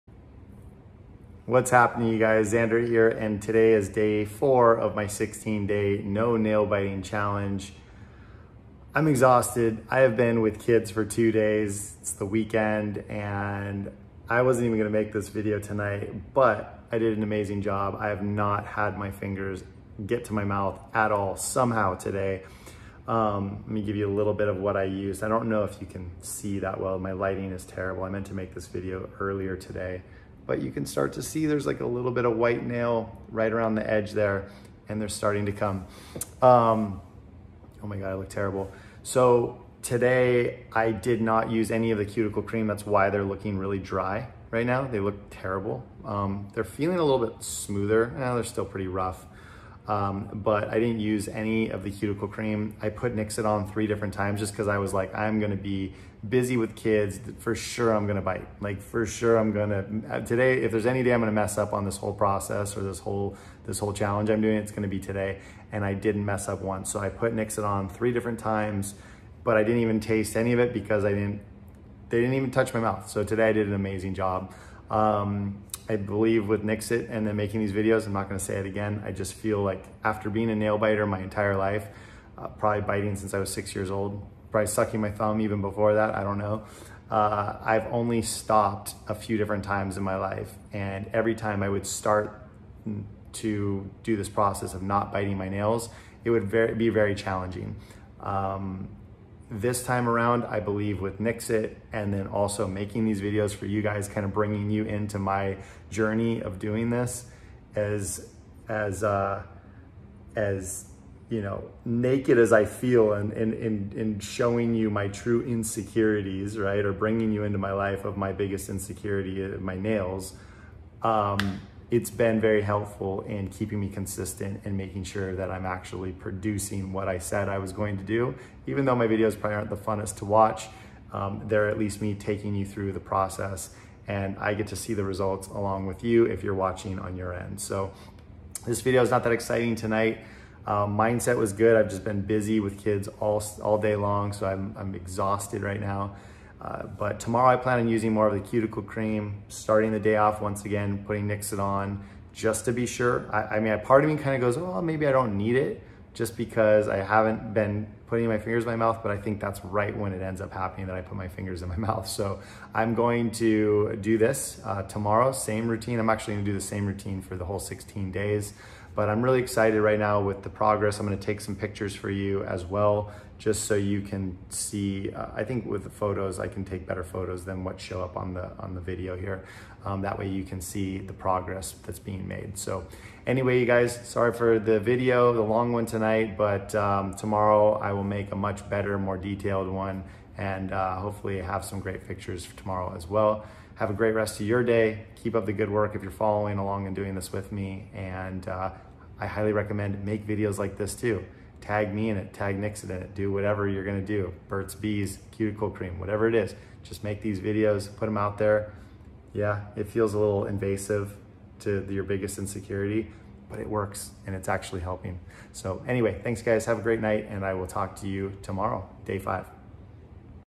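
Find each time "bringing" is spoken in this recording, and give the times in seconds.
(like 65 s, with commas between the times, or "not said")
104 s, 116 s.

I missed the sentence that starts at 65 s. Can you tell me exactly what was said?
And I didn't mess up once.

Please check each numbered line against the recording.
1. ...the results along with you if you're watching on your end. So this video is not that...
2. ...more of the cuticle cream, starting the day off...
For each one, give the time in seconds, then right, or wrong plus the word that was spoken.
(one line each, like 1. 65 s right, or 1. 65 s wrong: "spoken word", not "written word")
1. 134 s right
2. 148 s right.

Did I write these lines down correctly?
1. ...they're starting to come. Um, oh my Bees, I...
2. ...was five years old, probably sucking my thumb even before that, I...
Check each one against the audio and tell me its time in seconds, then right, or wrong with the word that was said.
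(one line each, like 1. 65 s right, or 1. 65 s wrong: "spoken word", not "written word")
1. 34 s wrong: "God", not "Bees"
2. 83 s wrong: "six", not "five".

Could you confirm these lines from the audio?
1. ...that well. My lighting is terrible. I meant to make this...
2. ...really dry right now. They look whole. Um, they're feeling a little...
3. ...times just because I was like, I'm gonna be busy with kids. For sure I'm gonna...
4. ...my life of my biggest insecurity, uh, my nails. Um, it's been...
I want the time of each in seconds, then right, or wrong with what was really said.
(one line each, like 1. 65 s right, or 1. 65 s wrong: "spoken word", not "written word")
1. 26 s right
2. 43 s wrong: "terrible", not "whole"
3. 54 s right
4. 117 s right.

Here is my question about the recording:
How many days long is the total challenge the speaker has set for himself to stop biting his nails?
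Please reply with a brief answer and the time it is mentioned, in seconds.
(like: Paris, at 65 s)
16, at 5 s.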